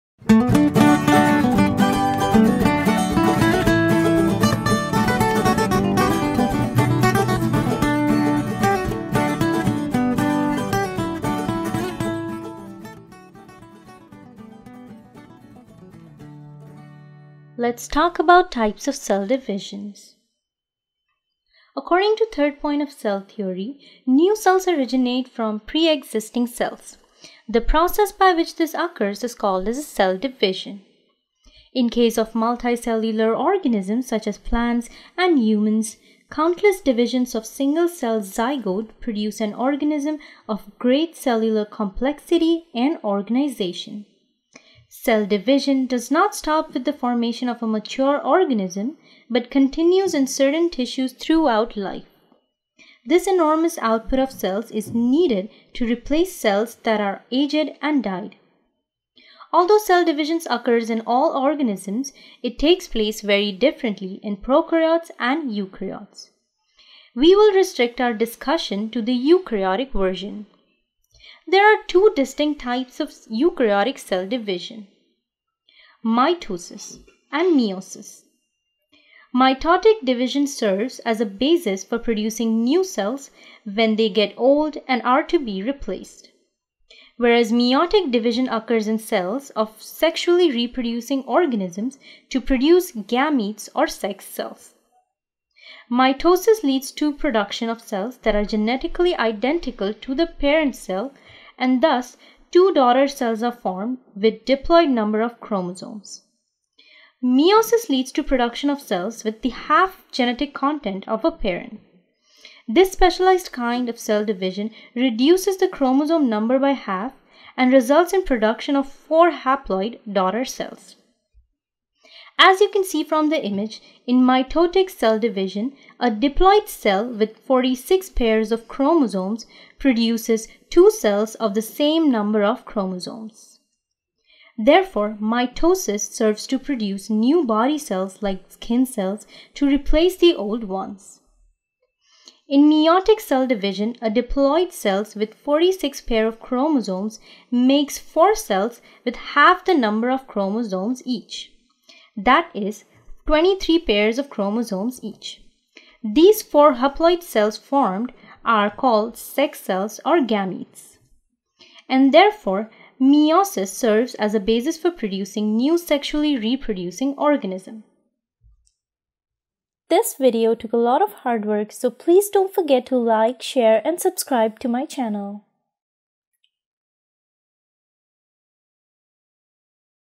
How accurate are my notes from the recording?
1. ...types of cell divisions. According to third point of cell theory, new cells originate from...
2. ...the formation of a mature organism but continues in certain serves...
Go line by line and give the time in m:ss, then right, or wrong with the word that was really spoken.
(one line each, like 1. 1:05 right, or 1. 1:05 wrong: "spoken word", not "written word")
1. 0:18 right
2. 0:46 wrong: "tissues", not "serves".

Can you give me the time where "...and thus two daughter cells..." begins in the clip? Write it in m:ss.
1:41.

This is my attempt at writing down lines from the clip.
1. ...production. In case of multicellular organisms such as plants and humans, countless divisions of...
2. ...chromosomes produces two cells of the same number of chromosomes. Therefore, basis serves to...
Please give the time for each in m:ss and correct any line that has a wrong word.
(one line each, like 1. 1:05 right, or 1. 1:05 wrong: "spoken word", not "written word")
1. 0:30 wrong: "division", not "production"
2. 2:08 wrong: "mitosis", not "basis".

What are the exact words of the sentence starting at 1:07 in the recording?
We will restrict our discussion to the eukaryotic version.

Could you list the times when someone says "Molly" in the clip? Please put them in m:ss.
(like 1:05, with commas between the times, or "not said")
not said.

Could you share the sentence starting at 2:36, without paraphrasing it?
These four haploid cells formed are called sex cells or gametes.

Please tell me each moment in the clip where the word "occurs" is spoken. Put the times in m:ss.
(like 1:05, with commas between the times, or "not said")
0:28, 1:00, 1:28.